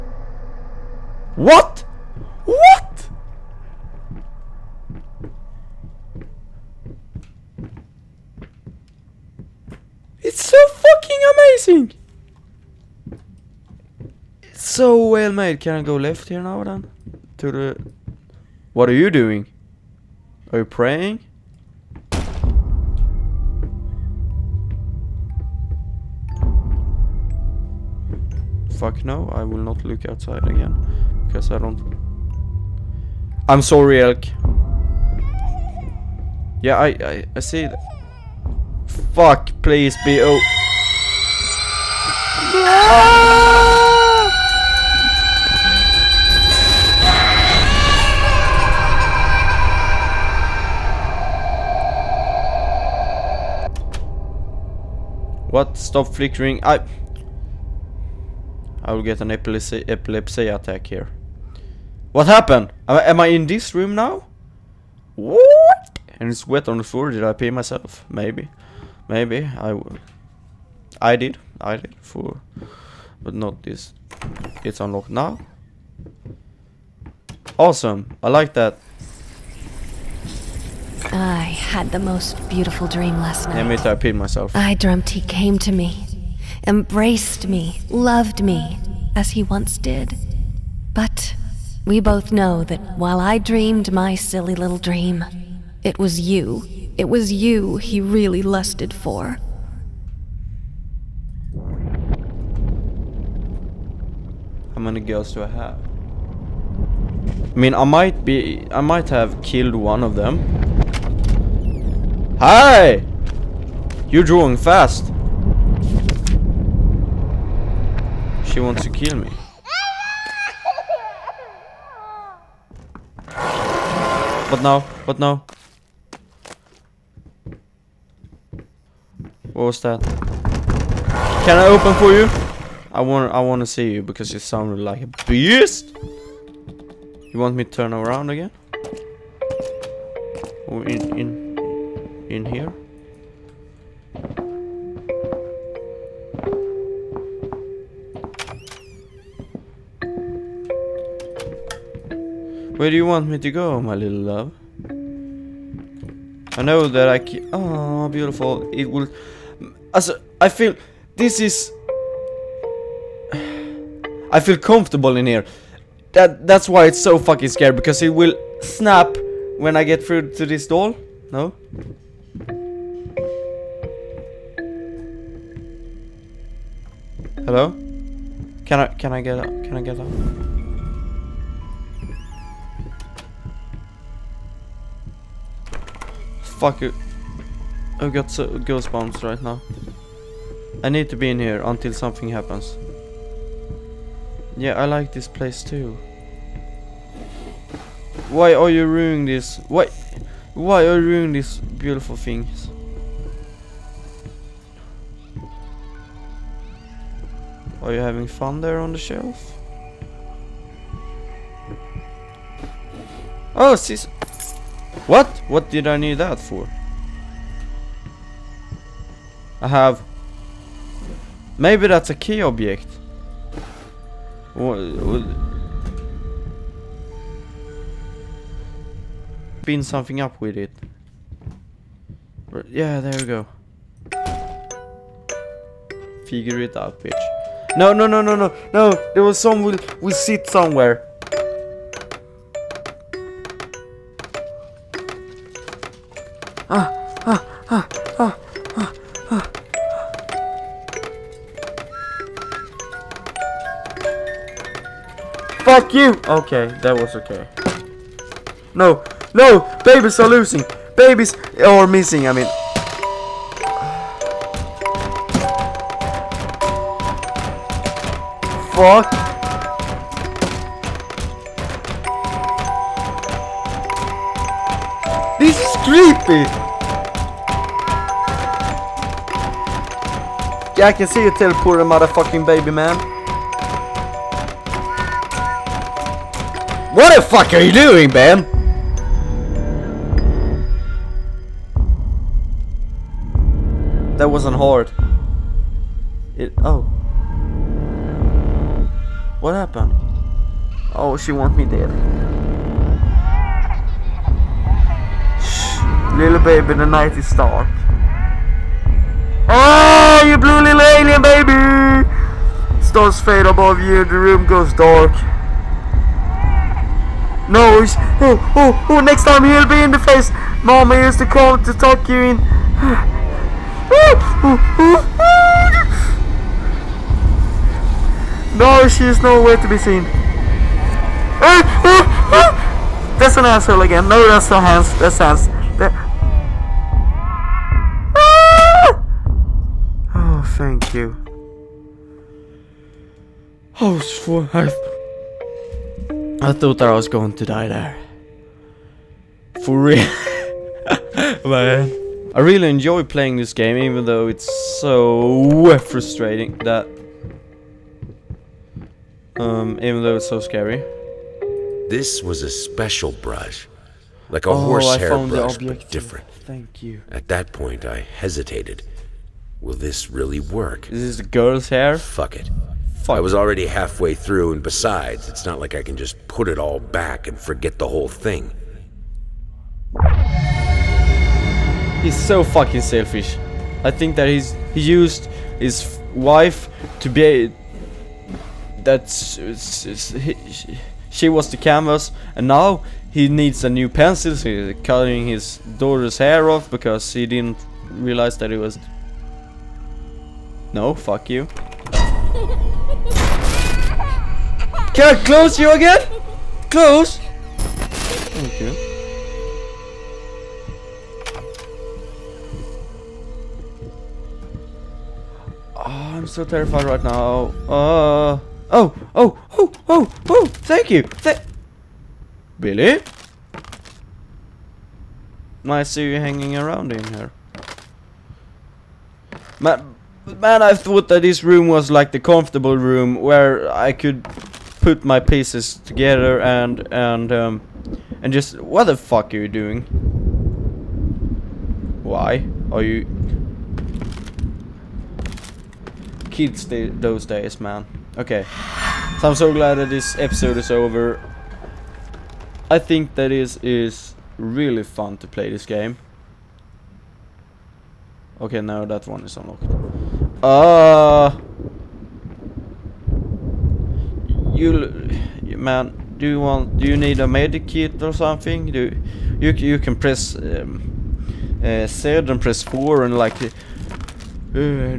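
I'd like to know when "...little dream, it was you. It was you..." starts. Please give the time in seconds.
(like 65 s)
94 s.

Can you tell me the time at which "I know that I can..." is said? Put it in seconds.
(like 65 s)
156 s.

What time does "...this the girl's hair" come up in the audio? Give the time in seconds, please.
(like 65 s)
371 s.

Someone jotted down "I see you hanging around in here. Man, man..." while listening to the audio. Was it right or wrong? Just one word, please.
right.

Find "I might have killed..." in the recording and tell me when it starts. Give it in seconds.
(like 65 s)
108 s.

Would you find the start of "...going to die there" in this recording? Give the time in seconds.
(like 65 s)
347 s.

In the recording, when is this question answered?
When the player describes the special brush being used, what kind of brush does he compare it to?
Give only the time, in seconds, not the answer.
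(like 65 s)
364 s.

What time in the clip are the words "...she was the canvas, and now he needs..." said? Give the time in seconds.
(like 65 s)
391 s.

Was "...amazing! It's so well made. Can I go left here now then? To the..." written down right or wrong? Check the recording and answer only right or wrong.
right.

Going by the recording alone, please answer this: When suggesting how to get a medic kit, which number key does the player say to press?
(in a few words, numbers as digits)
4.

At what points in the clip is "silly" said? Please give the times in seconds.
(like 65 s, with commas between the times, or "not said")
94 s.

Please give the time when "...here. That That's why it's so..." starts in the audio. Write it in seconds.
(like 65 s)
165 s.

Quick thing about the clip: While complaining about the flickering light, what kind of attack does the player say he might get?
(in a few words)
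epilepsy attack.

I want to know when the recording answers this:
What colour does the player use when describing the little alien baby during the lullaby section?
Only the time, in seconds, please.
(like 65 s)
310 s.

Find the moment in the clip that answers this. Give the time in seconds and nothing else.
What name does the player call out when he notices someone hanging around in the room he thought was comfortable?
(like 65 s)
422 s.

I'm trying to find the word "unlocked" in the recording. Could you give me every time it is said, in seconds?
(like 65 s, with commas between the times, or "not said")
74 s, 459 s.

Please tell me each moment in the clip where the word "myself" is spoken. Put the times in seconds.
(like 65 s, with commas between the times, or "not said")
67 s, 84 s.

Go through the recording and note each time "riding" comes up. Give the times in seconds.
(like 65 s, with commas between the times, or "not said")
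not said.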